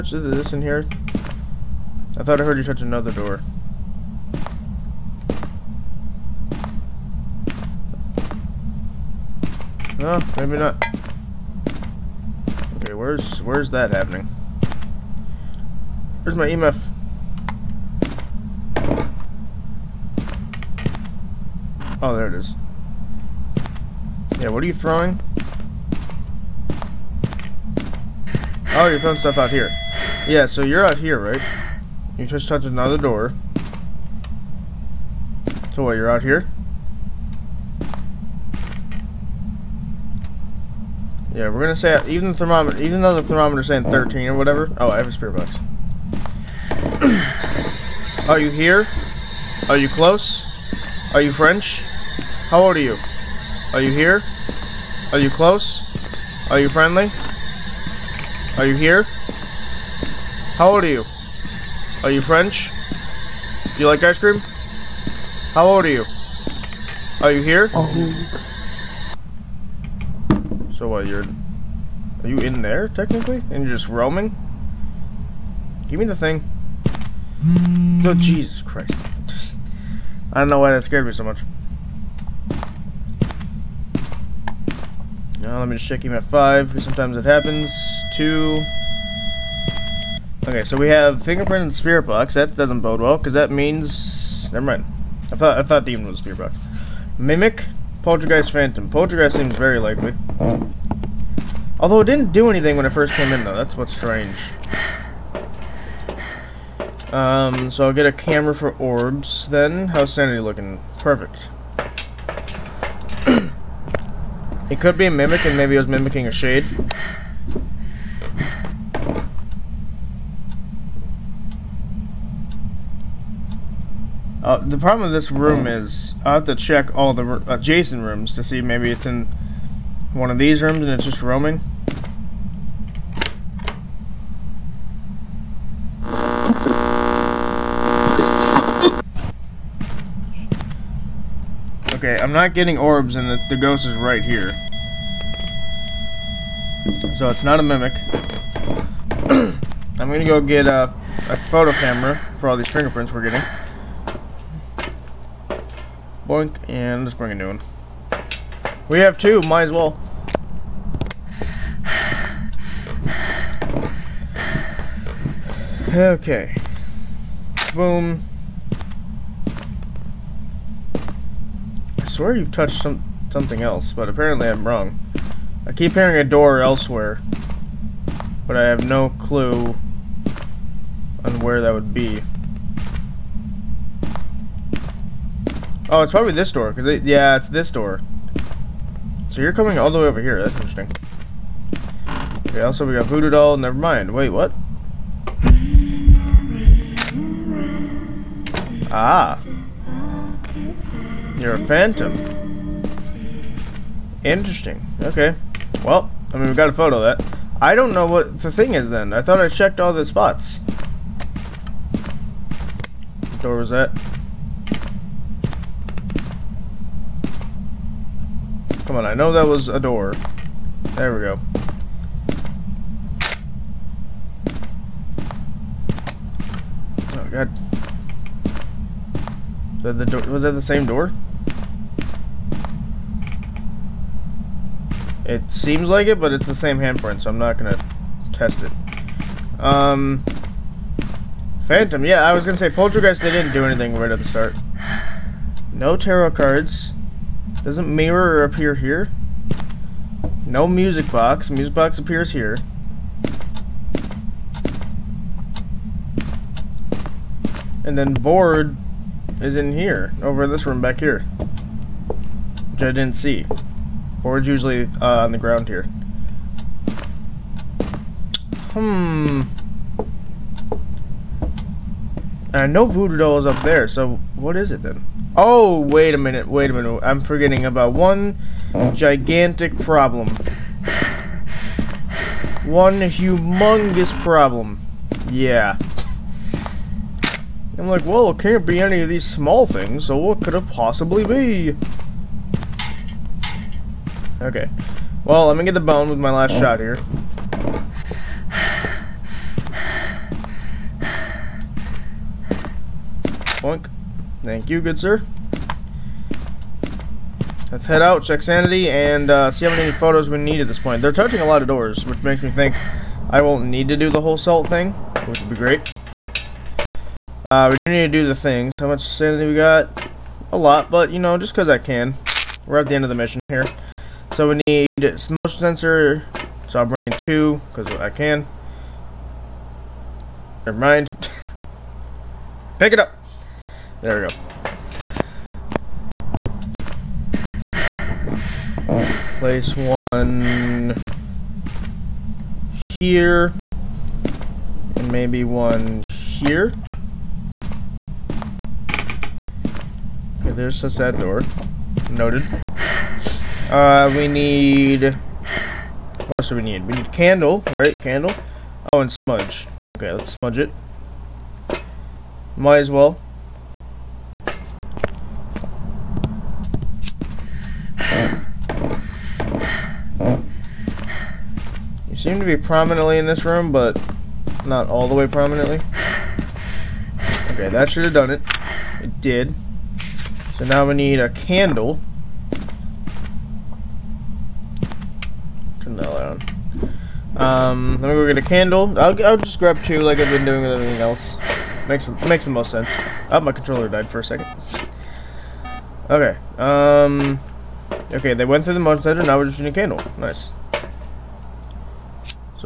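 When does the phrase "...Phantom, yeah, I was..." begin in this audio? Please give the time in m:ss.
4:01.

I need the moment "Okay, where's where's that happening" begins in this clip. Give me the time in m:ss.
0:12.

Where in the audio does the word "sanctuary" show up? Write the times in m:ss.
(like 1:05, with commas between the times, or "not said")
not said.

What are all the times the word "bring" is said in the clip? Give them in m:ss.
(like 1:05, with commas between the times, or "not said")
2:37, 5:26.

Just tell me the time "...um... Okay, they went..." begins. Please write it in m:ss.
6:36.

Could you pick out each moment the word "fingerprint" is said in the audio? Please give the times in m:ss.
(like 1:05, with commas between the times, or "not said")
1:31, 2:32.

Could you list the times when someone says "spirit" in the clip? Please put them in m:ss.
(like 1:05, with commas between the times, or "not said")
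1:31, 1:36.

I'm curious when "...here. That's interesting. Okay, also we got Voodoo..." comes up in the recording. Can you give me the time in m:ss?
3:10.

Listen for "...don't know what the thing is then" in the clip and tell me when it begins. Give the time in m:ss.
3:27.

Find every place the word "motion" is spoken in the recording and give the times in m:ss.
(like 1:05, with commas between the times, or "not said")
5:25, 6:38.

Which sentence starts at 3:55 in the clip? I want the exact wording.
It seems like it, but it's the same handprint, so I'm not gonna test it.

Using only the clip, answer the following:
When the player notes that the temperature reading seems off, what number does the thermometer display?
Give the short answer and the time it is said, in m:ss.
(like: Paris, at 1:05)
13, at 0:43.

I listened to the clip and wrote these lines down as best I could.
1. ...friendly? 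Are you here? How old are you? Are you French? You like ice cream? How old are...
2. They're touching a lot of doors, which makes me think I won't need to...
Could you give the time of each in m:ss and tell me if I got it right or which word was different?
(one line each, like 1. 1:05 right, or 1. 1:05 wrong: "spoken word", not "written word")
1. 0:56 right
2. 5:11 right.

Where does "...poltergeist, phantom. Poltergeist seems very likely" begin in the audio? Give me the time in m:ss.
1:38.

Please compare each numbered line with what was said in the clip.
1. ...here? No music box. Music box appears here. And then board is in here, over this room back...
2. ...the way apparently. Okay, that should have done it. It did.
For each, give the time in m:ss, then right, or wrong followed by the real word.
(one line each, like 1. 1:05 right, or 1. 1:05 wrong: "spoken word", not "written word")
1. 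4:08 right
2. 6:15 wrong: "prominently", not "apparently".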